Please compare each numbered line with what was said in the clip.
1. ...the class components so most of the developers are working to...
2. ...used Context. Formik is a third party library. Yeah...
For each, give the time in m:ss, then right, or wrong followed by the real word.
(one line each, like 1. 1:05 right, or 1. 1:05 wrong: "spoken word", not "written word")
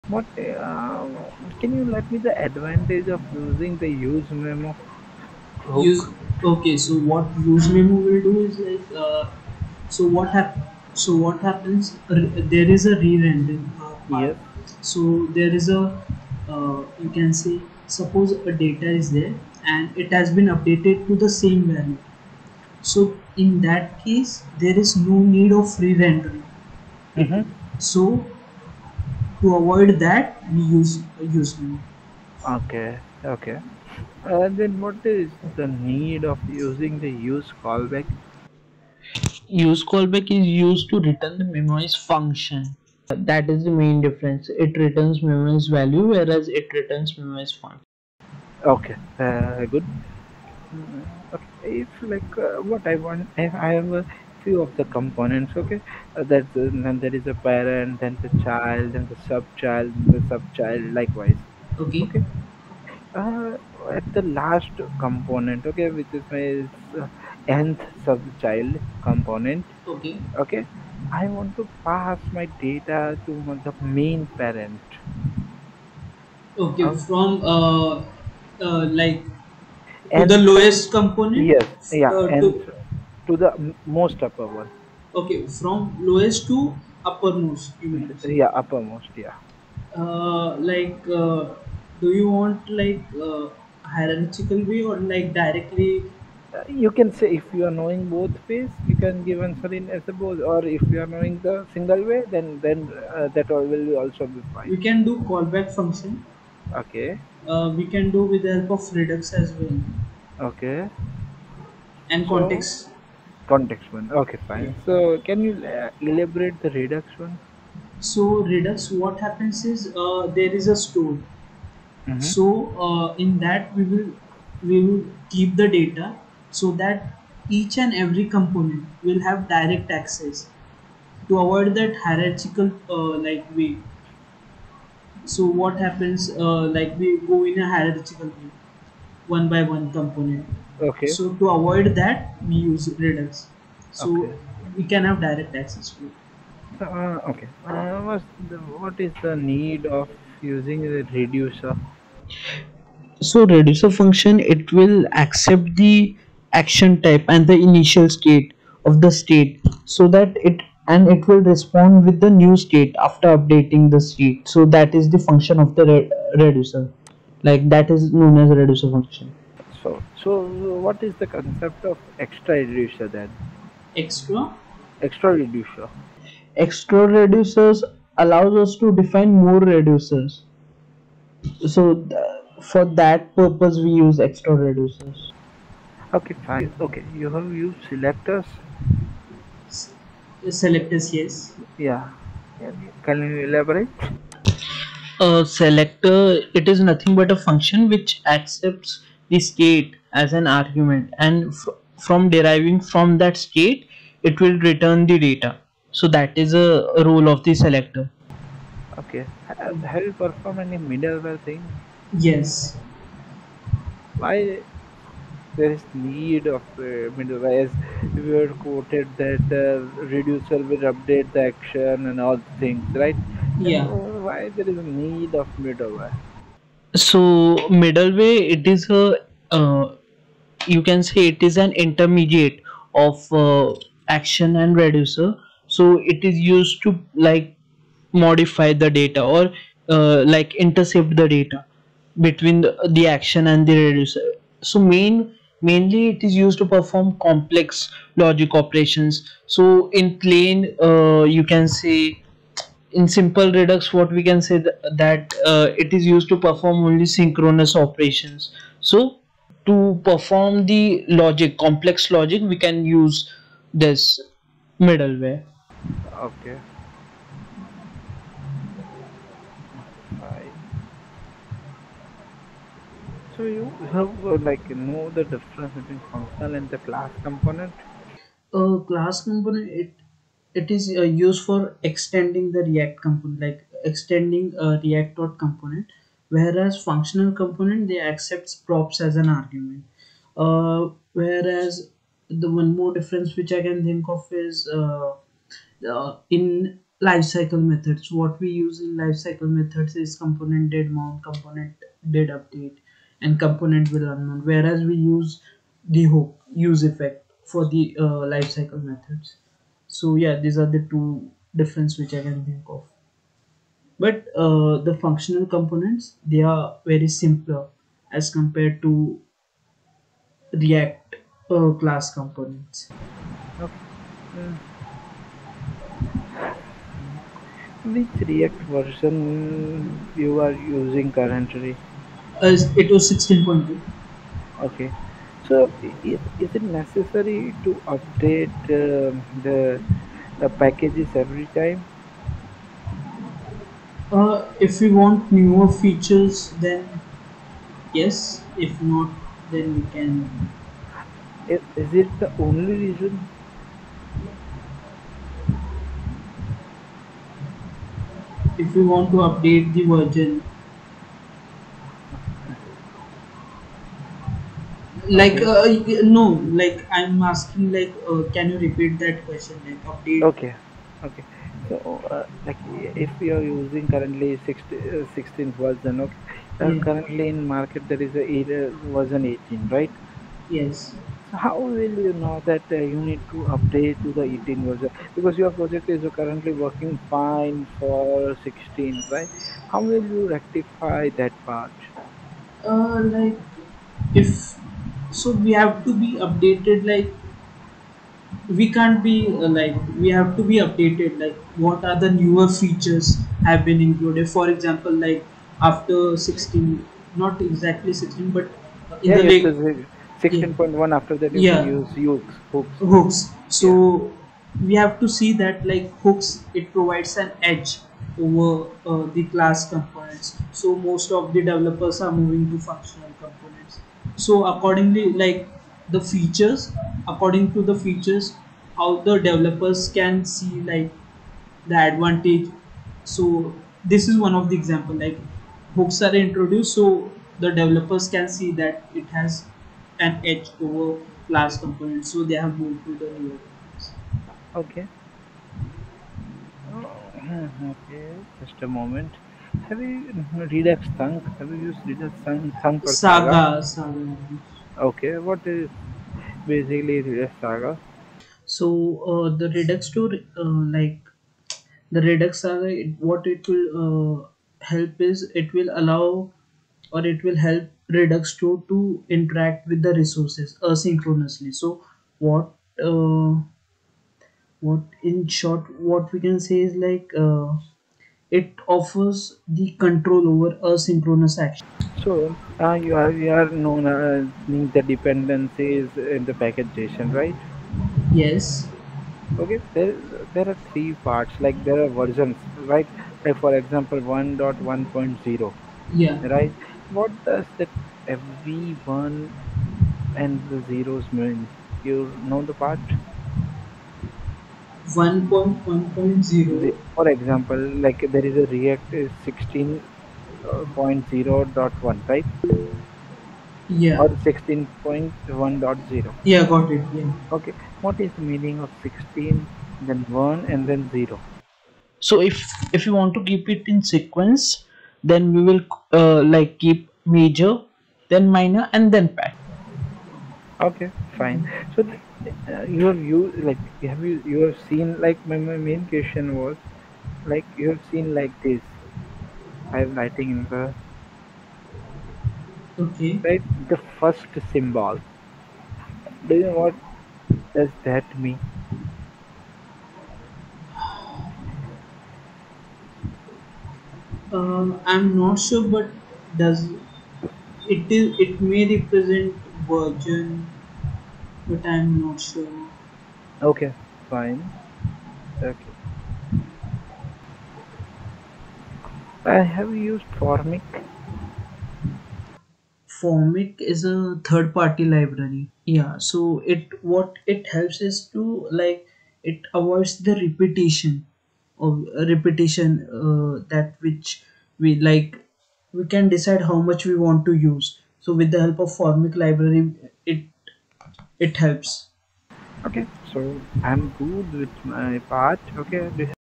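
1. 6:59 wrong: "moving", not "working"
2. 9:29 wrong: "Formik", not "Context".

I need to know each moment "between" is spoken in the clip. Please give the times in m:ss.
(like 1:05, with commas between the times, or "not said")
4:02, 4:35.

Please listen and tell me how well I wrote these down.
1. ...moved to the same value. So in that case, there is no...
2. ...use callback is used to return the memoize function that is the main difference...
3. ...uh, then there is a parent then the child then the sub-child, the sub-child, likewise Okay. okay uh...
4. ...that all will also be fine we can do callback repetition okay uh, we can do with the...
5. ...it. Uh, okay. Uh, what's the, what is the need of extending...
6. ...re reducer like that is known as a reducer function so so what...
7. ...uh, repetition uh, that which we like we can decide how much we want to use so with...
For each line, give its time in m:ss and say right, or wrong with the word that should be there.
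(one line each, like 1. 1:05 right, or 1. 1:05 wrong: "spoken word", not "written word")
1. 0:20 wrong: "updated", not "moved"
2. 0:39 right
3. 0:56 right
4. 1:43 wrong: "function", not "repetition"
5. 2:26 wrong: "using", not "extending"
6. 2:45 right
7. 9:41 right.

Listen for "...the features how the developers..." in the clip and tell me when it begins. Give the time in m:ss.
7:07.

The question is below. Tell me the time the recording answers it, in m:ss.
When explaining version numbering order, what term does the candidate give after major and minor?
8:49.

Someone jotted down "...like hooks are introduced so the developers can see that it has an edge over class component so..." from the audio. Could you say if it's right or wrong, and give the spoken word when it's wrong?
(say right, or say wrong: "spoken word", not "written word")
right.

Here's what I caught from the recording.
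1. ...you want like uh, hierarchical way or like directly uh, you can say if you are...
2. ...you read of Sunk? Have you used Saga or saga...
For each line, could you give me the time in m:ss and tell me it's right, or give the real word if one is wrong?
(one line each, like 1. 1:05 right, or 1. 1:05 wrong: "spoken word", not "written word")
1. 1:32 right
2. 7:29 wrong: "Redux", not "Saga".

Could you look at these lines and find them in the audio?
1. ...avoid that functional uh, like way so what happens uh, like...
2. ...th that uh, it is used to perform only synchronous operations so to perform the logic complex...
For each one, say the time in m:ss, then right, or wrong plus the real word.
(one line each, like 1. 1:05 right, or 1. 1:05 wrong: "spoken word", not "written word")
1. 2:11 wrong: "hierarchical", not "functional"
2. 4:14 right.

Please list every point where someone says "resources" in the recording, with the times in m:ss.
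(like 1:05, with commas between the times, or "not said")
7:49.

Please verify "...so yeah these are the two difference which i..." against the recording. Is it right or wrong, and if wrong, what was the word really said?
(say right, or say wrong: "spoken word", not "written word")
right.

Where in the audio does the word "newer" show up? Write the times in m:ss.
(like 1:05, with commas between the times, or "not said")
5:45, 6:42, 7:23.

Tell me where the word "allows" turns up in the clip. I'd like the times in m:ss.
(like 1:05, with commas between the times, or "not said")
2:58, 7:45.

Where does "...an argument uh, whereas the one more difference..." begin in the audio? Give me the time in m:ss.
4:49.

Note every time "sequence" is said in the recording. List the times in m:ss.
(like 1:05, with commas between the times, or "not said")
8:43.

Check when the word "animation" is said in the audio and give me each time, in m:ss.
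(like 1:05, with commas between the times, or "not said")
not said.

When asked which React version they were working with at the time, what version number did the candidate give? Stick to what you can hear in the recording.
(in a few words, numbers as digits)
16.2.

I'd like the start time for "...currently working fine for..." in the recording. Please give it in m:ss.
6:26.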